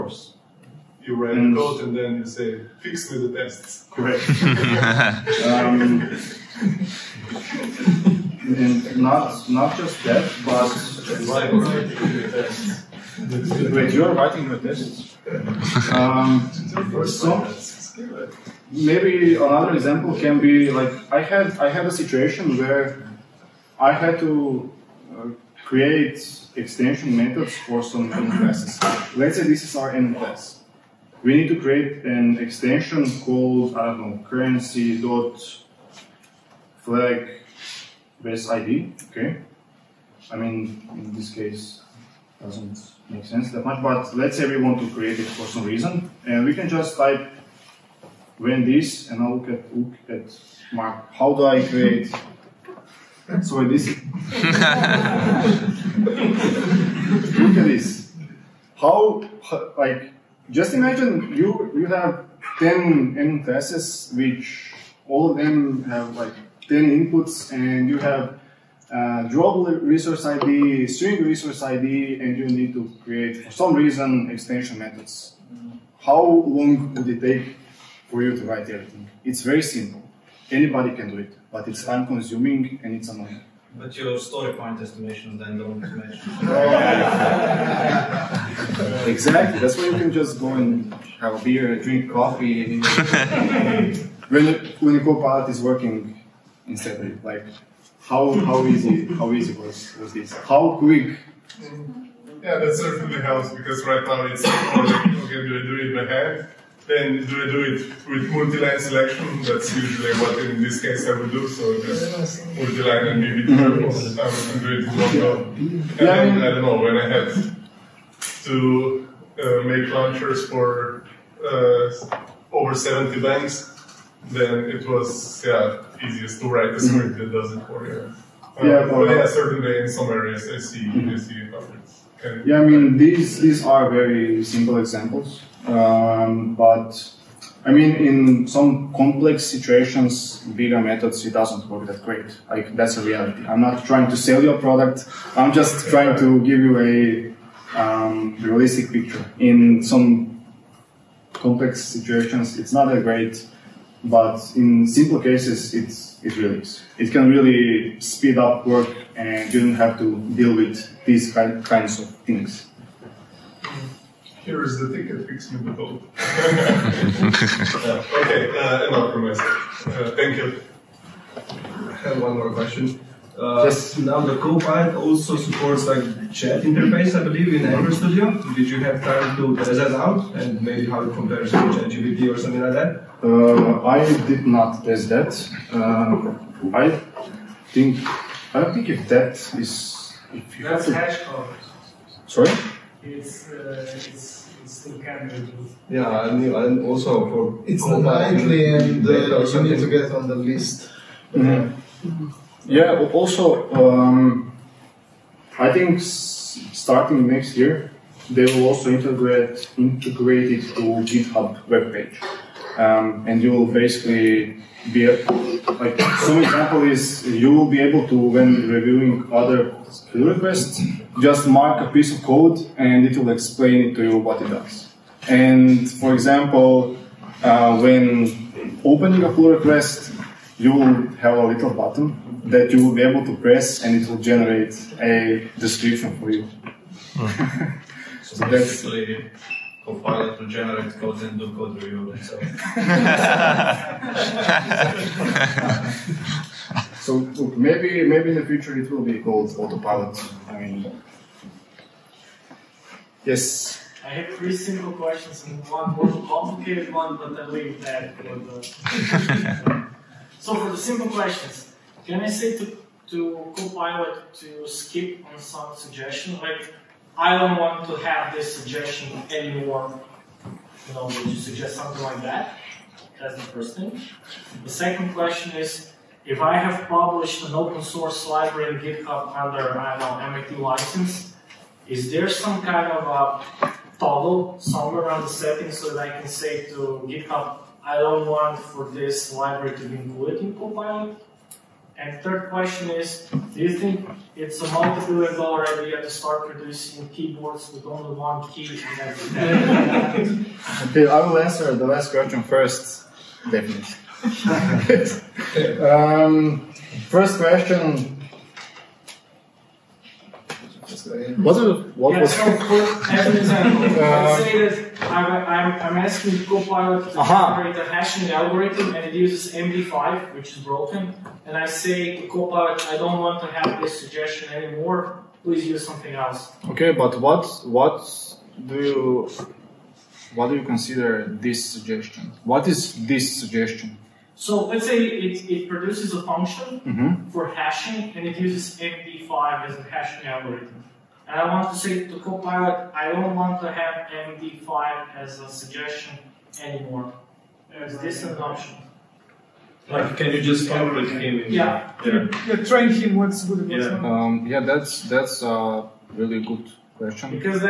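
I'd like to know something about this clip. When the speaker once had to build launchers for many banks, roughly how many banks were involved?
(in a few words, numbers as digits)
over 70.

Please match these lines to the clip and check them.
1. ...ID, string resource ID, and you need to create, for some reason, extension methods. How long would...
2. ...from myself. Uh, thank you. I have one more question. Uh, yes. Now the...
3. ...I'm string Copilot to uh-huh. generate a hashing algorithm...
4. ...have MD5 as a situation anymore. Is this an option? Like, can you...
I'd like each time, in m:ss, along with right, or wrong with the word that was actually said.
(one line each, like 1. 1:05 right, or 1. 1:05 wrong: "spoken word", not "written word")
1. 1:10 right
2. 2:49 right
3. 5:15 wrong: "asking", not "string"
4. 5:43 wrong: "suggestion", not "situation".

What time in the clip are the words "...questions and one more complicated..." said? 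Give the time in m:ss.
4:14.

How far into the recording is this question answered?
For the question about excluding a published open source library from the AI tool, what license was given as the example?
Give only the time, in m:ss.
4:40.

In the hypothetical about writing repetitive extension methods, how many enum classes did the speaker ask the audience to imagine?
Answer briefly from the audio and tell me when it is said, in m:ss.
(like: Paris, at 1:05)
10, at 1:02.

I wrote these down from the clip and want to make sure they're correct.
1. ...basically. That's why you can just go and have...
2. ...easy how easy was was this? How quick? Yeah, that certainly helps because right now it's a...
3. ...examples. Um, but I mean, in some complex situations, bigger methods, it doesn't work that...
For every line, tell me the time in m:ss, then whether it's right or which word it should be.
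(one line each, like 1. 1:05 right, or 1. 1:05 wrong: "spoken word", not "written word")
1. 1:29 wrong: "exactly", not "basically"
2. 1:38 right
3. 2:14 right.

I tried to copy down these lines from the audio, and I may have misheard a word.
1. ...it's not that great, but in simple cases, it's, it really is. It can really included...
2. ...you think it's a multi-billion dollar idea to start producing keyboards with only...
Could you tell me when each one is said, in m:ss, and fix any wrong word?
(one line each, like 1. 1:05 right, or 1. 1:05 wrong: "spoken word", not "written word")
1. 2:32 wrong: "speed", not "included"
2. 4:53 right.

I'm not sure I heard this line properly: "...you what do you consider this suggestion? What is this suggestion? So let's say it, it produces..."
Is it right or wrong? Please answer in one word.
right.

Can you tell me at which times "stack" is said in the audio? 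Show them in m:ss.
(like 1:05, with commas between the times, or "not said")
not said.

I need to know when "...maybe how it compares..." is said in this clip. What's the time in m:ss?
3:00.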